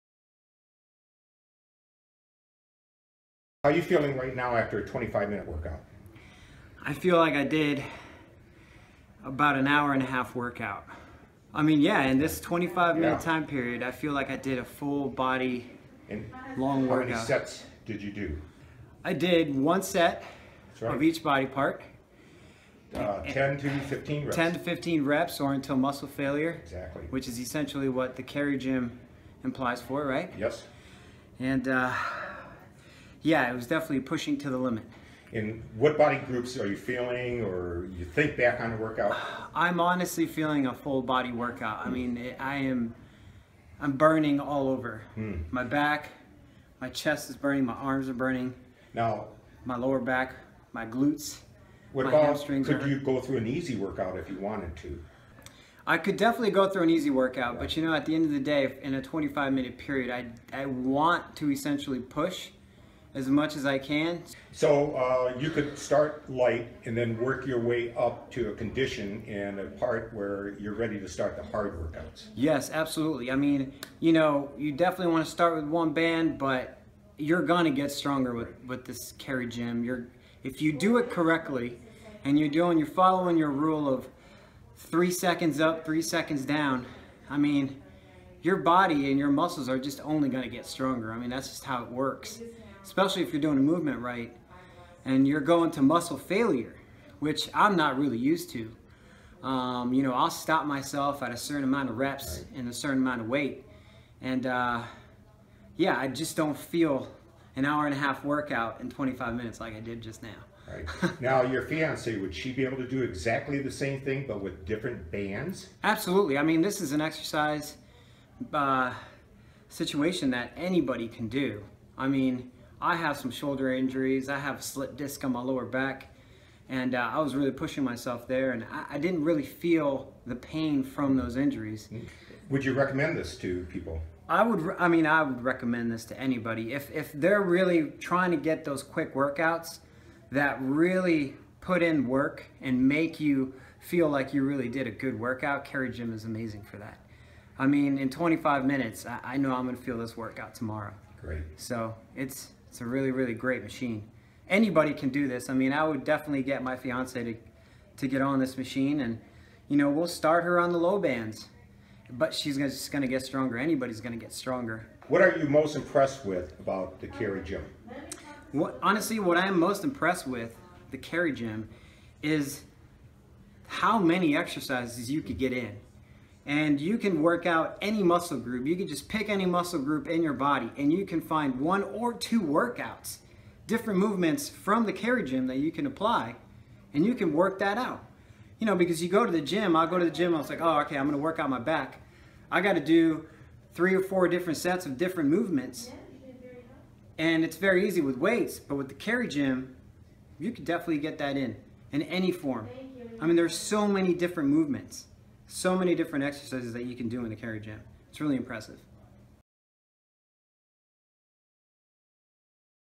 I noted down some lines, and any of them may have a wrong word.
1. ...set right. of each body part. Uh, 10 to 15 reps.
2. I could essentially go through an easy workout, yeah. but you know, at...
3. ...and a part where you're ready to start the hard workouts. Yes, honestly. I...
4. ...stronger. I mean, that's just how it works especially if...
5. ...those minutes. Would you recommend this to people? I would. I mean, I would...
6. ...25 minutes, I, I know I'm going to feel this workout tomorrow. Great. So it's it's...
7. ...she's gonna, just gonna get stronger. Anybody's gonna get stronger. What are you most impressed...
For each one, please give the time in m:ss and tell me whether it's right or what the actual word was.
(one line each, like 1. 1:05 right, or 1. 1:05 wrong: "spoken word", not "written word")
1. 0:19 right
2. 0:55 wrong: "definitely", not "essentially"
3. 1:09 wrong: "absolutely", not "honestly"
4. 1:30 right
5. 2:11 wrong: "injuries", not "minutes"
6. 2:28 right
7. 2:42 right.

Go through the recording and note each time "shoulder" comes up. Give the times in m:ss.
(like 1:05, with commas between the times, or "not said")
2:03.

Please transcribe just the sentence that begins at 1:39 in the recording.
Um, you know, I'll stop myself at a certain amount of reps and a certain amount of weight.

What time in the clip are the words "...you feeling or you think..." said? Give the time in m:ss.
0:36.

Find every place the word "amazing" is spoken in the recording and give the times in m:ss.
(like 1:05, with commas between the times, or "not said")
2:26.